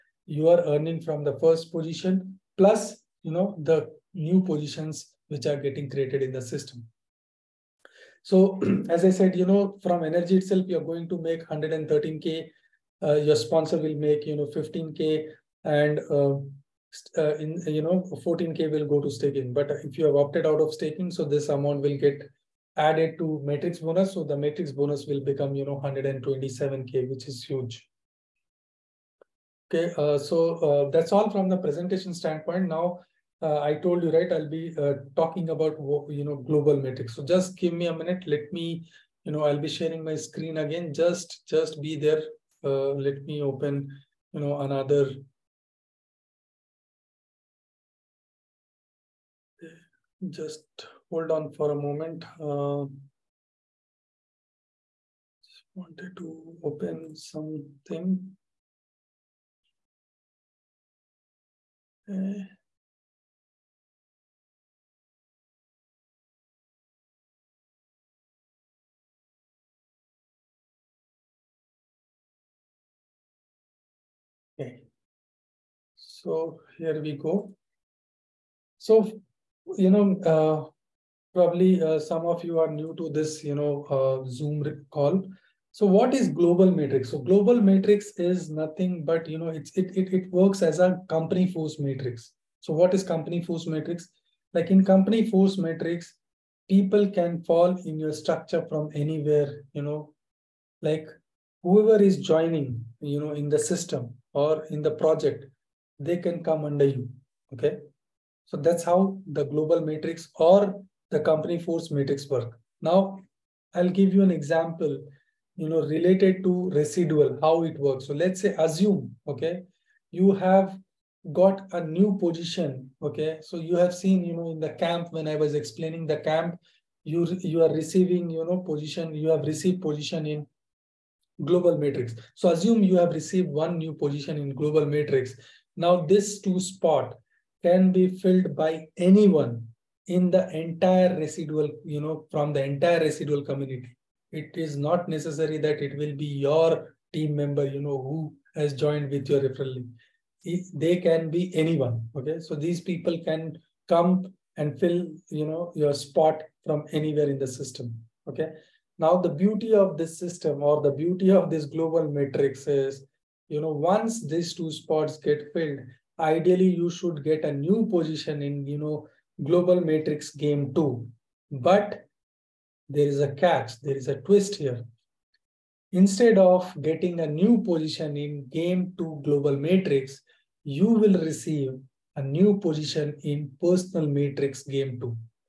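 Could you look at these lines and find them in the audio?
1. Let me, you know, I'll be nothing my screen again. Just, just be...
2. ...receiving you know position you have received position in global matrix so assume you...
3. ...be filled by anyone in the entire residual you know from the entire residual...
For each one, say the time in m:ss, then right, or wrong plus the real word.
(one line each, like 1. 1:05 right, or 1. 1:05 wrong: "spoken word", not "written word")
1. 0:38 wrong: "sharing", not "nothing"
2. 2:07 right
3. 2:17 right.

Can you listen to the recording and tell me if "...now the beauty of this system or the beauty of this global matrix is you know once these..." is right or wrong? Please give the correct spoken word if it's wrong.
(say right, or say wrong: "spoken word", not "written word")
right.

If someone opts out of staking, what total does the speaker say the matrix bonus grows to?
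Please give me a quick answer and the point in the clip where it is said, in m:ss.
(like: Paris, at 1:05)
127k, at 0:25.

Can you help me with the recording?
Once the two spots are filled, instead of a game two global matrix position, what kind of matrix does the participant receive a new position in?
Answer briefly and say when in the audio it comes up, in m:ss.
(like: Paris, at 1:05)
personal matrix, at 3:03.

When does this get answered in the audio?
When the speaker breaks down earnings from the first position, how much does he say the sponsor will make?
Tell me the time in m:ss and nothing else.
0:14.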